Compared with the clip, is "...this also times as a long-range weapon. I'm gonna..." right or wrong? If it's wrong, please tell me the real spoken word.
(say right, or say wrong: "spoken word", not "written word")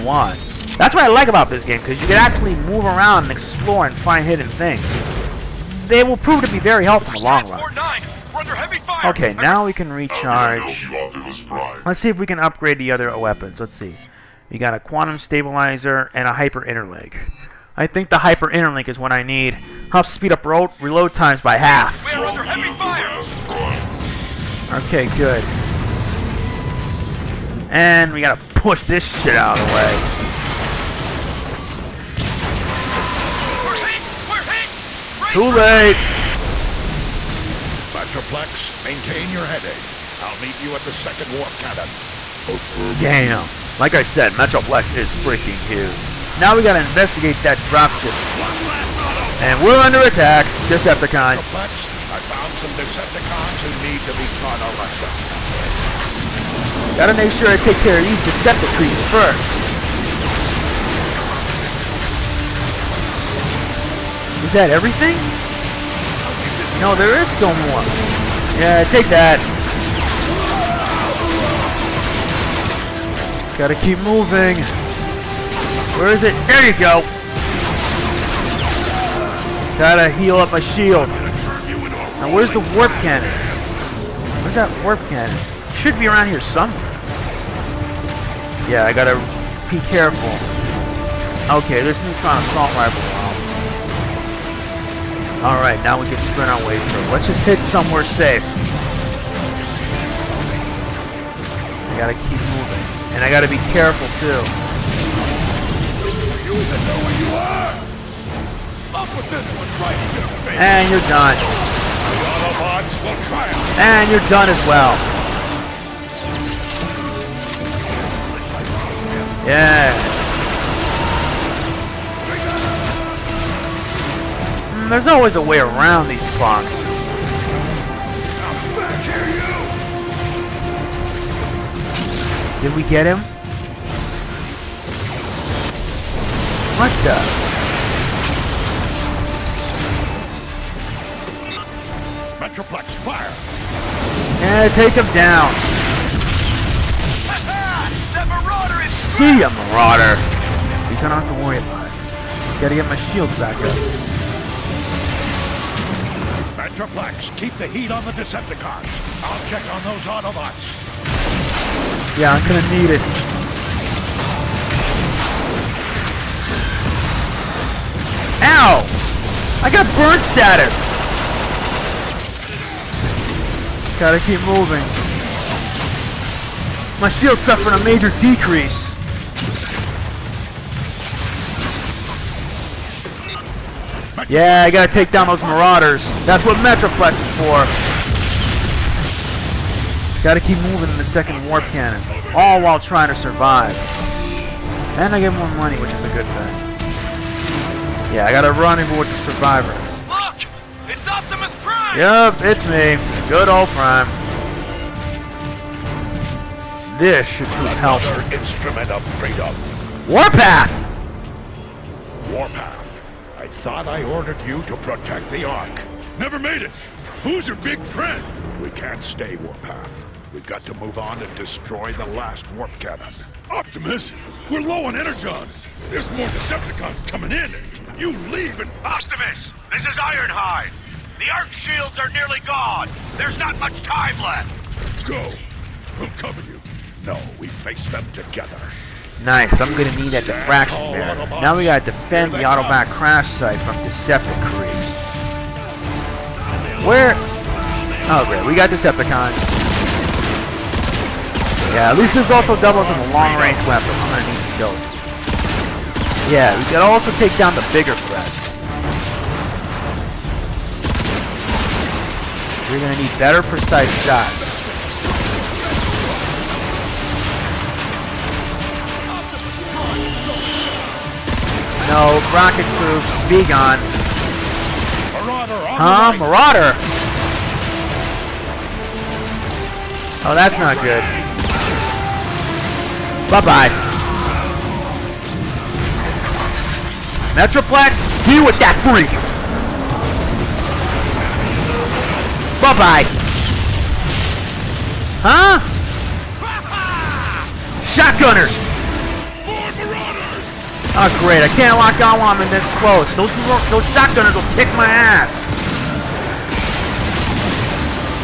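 wrong: "doubles", not "times".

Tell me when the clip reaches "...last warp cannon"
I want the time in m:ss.
3:42.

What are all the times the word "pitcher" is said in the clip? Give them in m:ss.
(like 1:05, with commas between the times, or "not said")
not said.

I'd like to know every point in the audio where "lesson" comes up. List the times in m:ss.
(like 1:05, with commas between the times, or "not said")
0:54.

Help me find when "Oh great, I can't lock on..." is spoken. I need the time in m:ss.
5:00.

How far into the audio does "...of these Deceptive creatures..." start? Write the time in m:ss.
0:57.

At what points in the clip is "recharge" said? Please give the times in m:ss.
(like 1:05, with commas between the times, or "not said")
0:09.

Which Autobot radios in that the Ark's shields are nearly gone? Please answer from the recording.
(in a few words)
Ironhide.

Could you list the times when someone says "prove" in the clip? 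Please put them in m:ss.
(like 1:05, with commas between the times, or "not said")
0:06, 3:27.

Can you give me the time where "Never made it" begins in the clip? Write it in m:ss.
3:36.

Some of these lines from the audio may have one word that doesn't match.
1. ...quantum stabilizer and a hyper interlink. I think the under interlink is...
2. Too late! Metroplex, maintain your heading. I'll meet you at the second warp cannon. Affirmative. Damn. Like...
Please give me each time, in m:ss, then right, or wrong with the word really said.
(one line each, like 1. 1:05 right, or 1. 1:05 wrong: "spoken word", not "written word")
1. 0:14 wrong: "hyper", not "under"
2. 0:35 right.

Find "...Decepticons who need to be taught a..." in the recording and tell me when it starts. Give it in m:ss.
0:52.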